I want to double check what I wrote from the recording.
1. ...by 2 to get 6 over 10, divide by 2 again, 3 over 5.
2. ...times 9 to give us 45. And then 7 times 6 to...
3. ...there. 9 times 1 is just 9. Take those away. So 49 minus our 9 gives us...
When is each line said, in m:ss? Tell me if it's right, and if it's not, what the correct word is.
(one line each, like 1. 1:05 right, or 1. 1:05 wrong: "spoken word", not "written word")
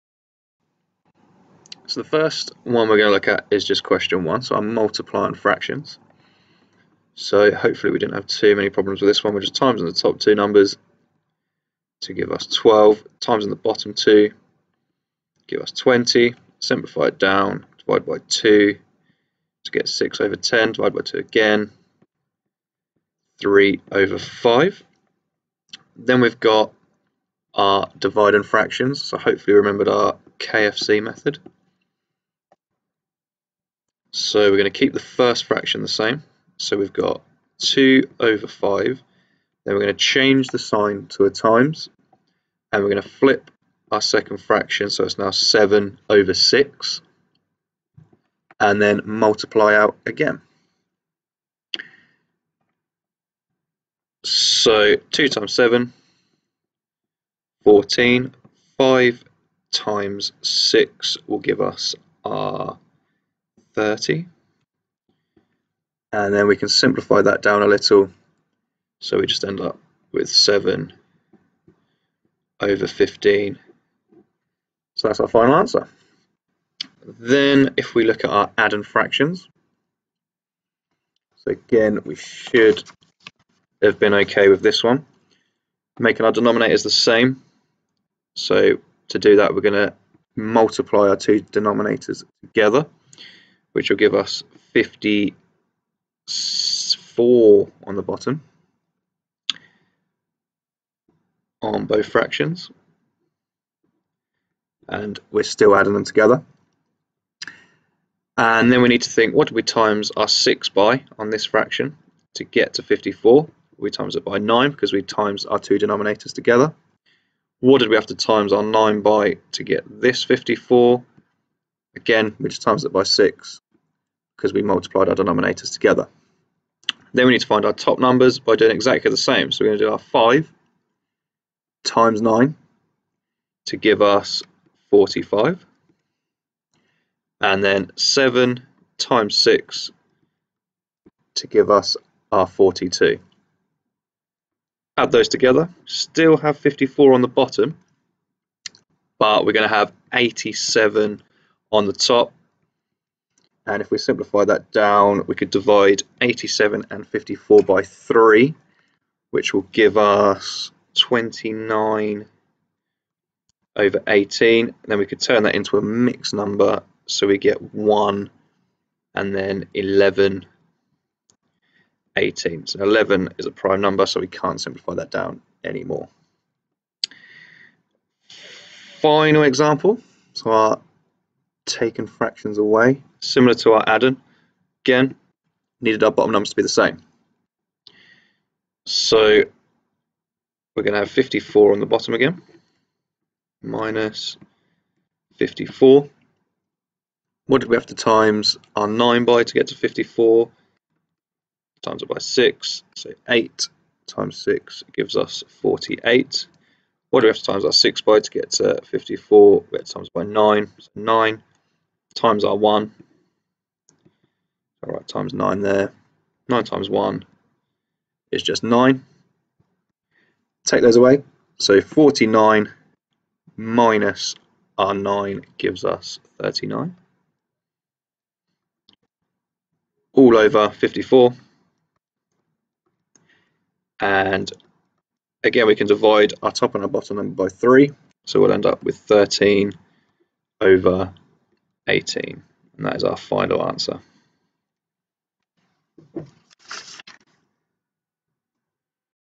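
1. 0:18 right
2. 2:11 right
3. 3:35 right.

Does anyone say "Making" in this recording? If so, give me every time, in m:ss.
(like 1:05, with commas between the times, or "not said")
1:25.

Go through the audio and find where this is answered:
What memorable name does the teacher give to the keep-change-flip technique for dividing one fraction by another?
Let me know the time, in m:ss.
0:30.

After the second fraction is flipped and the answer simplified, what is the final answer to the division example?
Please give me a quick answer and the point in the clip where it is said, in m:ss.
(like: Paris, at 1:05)
7/15, at 1:10.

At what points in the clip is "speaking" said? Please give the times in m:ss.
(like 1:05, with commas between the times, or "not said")
not said.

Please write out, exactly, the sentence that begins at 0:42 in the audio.
And we're going to flip our second fraction.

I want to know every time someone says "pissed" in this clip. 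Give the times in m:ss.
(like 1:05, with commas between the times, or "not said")
not said.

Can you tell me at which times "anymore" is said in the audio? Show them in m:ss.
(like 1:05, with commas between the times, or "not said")
2:55.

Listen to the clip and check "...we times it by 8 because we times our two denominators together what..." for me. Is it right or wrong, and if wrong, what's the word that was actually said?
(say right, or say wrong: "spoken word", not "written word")
wrong: "9", not "8".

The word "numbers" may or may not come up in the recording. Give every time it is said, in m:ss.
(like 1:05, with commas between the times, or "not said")
0:10, 2:07, 2:46, 2:53, 3:06, 3:57.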